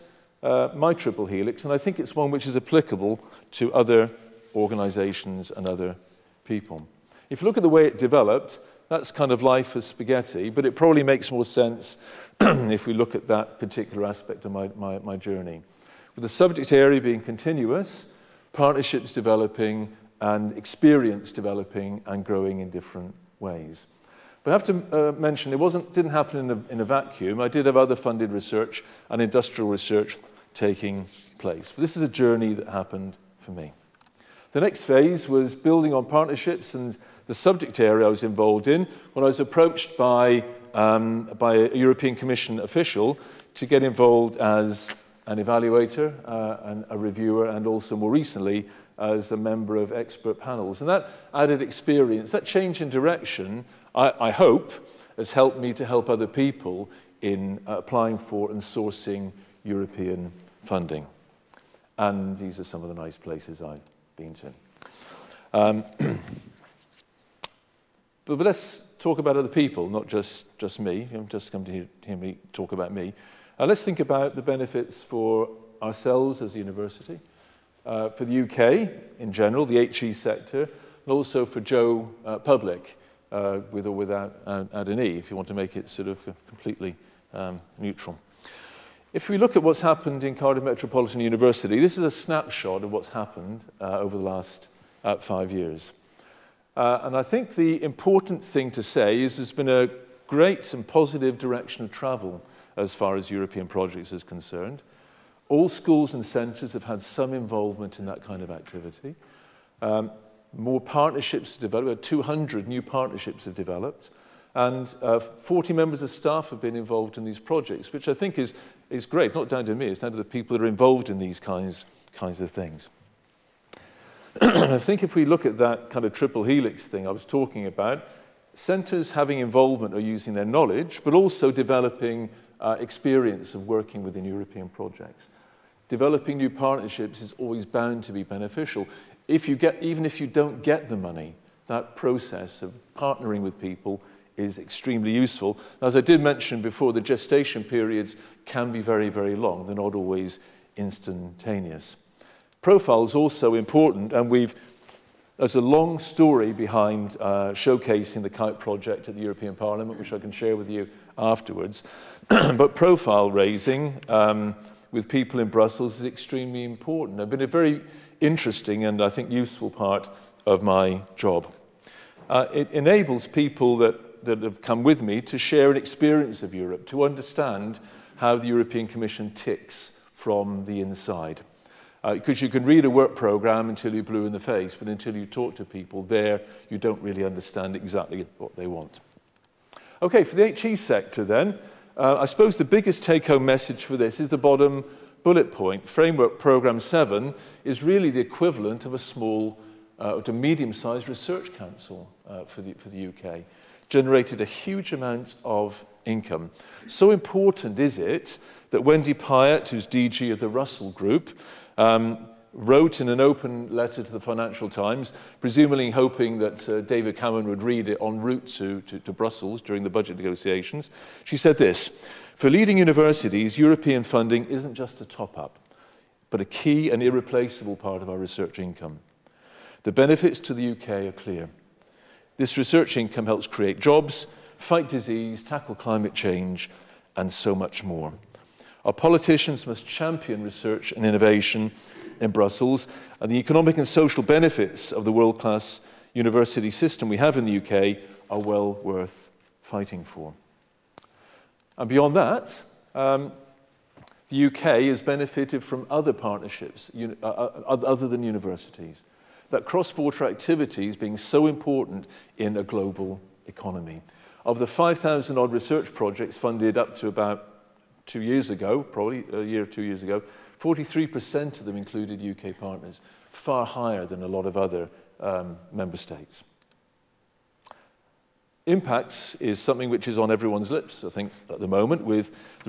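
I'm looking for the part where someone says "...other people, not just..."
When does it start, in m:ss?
1:09.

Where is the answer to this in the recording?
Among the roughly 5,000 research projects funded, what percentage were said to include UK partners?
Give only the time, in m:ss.
4:30.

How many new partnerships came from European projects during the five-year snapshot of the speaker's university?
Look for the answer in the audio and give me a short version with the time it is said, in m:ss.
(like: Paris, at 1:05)
200, at 1:52.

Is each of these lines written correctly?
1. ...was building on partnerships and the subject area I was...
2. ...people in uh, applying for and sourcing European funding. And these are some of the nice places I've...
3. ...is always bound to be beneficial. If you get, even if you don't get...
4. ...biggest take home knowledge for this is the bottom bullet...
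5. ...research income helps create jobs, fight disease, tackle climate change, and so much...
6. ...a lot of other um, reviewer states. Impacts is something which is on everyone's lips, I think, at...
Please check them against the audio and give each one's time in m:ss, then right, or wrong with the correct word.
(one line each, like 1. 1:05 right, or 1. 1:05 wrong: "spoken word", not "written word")
1. 0:35 right
2. 0:56 right
3. 2:17 right
4. 3:12 wrong: "message", not "knowledge"
5. 3:52 right
6. 4:34 wrong: "member", not "reviewer".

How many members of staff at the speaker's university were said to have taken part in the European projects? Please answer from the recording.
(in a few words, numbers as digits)
40.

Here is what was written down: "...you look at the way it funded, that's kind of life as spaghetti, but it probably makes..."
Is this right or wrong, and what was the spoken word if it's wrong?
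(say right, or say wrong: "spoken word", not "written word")
wrong: "developed", not "funded".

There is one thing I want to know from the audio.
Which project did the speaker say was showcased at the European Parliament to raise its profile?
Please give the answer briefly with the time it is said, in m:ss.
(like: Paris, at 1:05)
The kite project, at 2:38.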